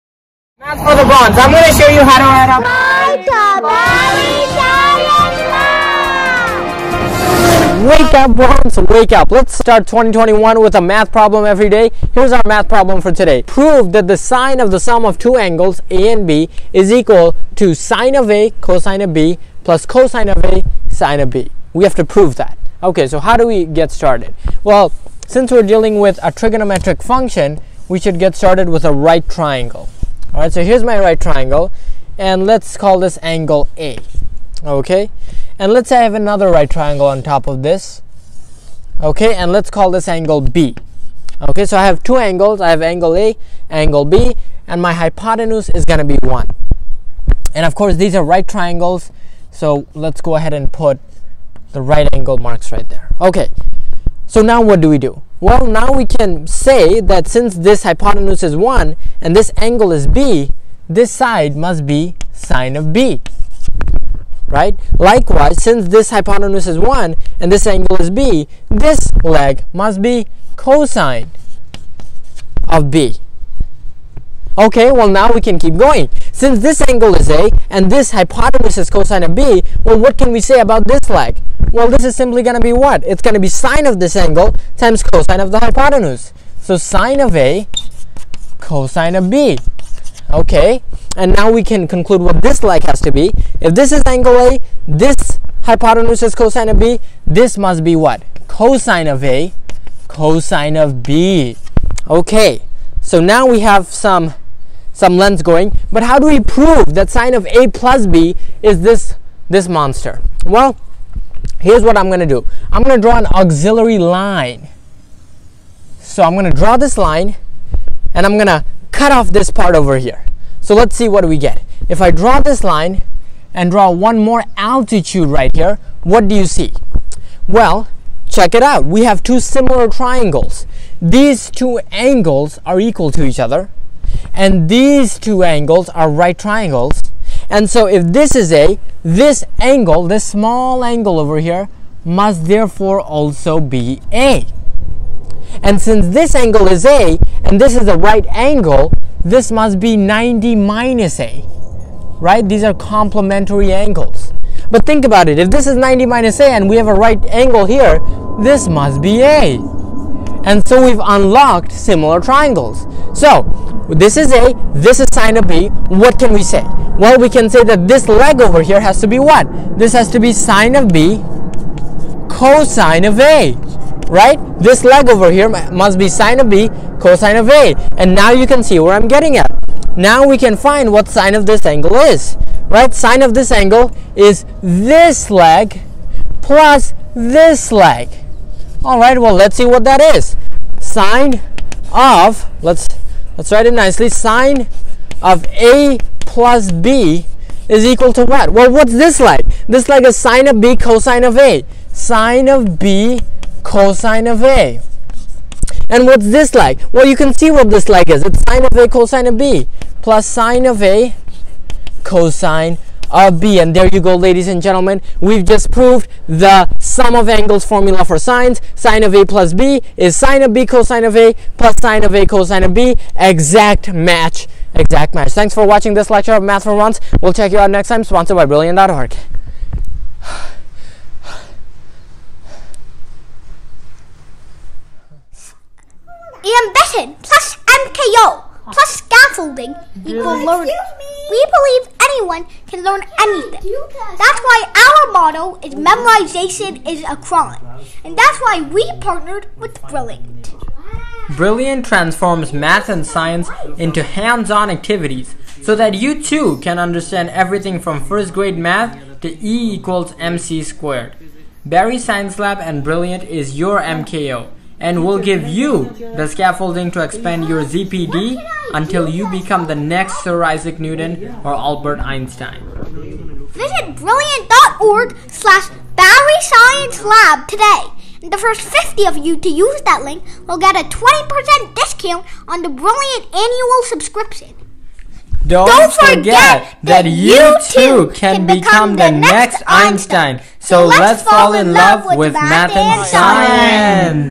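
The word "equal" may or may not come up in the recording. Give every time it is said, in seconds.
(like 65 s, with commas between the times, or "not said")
16 s, 132 s, 197 s, 240 s, 259 s.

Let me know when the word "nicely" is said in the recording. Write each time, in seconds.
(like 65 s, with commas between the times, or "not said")
193 s.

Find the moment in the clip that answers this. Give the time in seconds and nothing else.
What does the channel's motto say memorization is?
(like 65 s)
245 s.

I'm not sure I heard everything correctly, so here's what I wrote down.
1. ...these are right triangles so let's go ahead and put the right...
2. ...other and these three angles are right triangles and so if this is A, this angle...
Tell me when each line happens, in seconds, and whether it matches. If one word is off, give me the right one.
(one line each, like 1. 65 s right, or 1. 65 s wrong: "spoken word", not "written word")
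1. 47 s right
2. 133 s wrong: "two", not "three".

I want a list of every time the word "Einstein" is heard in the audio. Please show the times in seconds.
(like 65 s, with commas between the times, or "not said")
271 s, 289 s.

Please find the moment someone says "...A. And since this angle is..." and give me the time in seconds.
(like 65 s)
144 s.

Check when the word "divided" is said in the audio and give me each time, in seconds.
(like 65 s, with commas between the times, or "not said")
not said.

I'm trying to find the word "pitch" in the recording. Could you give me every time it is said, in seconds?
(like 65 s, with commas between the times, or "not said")
not said.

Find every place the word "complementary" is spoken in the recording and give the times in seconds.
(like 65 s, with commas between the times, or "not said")
152 s.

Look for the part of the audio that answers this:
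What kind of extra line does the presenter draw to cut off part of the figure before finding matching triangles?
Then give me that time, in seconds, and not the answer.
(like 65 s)
113 s.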